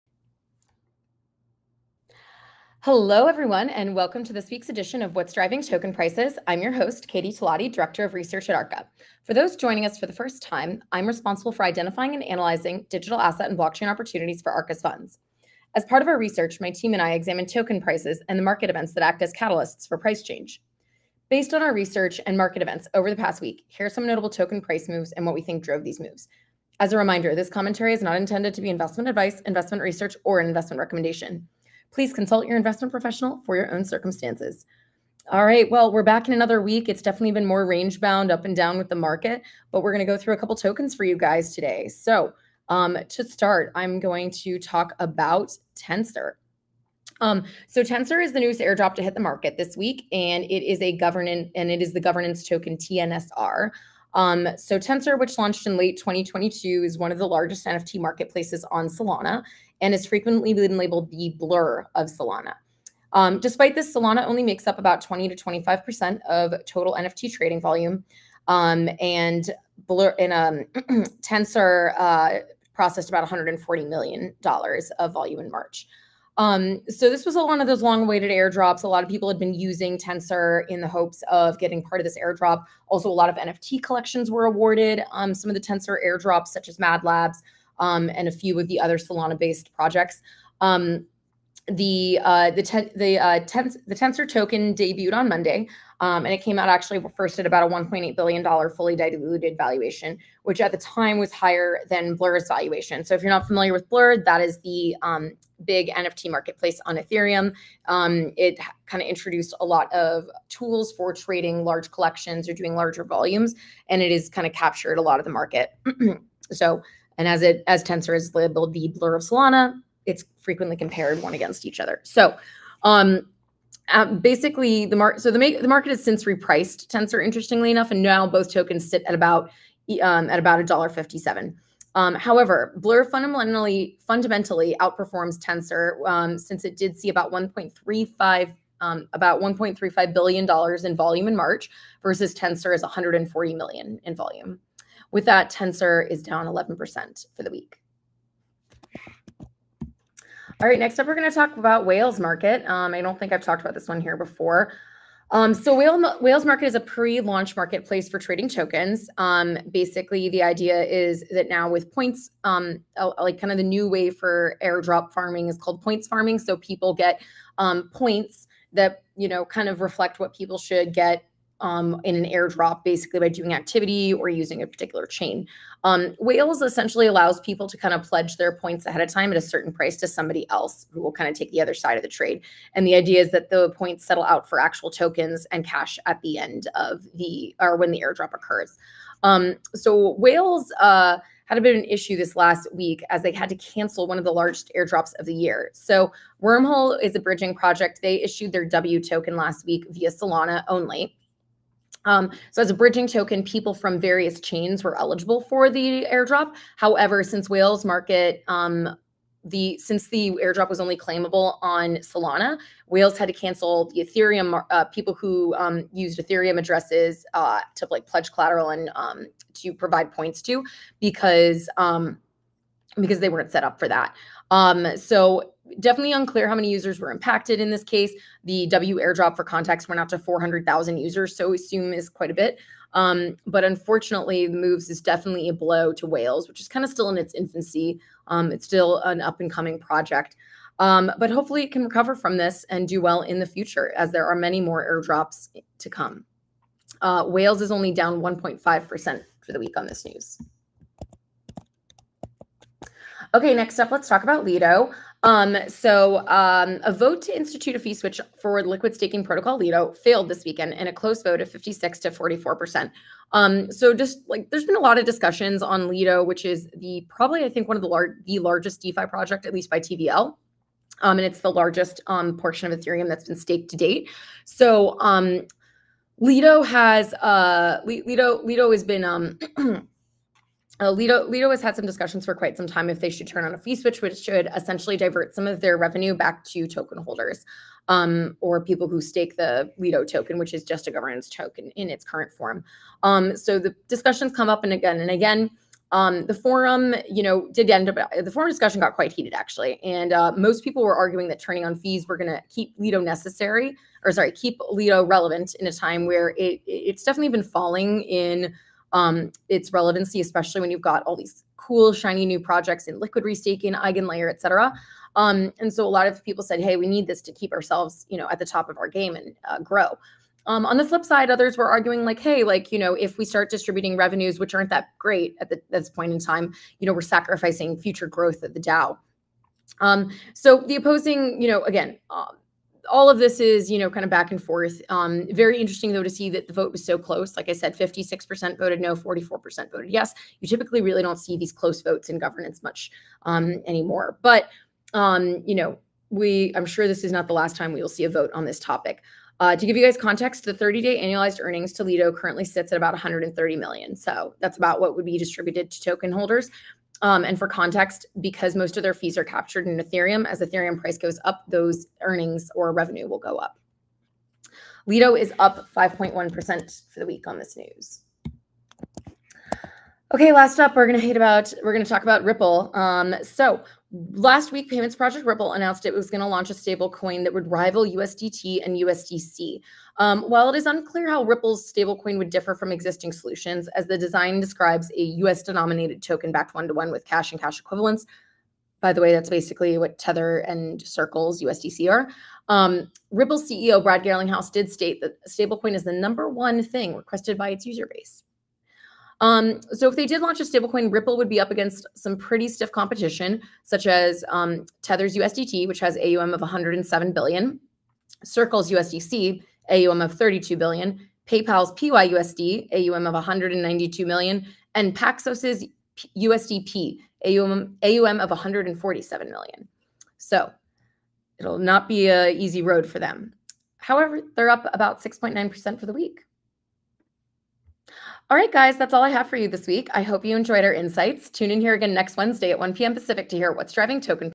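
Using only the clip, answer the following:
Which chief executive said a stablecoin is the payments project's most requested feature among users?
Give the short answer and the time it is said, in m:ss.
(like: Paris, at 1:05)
Brad Garlinghouse, at 6:33.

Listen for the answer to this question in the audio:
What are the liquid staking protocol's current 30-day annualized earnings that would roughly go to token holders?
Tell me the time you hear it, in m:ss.
5:52.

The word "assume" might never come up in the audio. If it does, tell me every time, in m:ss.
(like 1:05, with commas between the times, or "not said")
3:51.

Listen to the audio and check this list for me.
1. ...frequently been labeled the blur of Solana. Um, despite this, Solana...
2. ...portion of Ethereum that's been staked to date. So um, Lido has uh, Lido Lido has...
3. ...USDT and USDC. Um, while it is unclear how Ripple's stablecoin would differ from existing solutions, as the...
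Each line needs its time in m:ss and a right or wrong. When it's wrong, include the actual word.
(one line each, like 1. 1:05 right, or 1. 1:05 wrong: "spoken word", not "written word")
1. 1:00 right
2. 4:32 right
3. 6:17 right.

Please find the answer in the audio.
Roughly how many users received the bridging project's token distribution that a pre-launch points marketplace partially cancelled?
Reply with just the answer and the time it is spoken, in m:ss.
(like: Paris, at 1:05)
400,000, at 3:50.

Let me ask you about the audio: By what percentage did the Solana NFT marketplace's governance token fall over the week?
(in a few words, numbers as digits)
11%.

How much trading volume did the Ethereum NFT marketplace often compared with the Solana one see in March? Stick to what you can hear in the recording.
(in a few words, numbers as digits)
$1.35 billion.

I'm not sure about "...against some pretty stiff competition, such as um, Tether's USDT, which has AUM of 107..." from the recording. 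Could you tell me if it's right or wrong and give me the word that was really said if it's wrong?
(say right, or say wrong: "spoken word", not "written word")
right.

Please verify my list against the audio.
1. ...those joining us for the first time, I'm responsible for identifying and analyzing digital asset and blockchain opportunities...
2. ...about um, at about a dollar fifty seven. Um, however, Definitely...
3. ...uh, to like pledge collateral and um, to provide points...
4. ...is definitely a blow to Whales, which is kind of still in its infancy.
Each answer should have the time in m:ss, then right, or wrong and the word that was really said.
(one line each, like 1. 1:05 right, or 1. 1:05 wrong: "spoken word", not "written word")
1. 0:09 right
2. 2:09 wrong: "Blur", not "Definitely"
3. 3:37 right
4. 3:54 right.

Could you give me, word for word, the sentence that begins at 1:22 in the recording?
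Also, a lot of NFT collections were awarded.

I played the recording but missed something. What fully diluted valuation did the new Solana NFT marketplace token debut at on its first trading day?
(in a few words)
$1.8 billion.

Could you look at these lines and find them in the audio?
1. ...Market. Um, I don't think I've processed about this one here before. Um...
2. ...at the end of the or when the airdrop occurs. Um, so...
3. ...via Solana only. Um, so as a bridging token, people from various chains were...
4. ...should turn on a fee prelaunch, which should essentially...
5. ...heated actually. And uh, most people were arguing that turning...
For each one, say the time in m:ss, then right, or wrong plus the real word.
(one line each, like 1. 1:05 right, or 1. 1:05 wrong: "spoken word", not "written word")
1. 2:32 wrong: "talked", not "processed"
2. 3:06 right
3. 3:19 right
4. 4:43 wrong: "switch", not "prelaunch"
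5. 4:59 right.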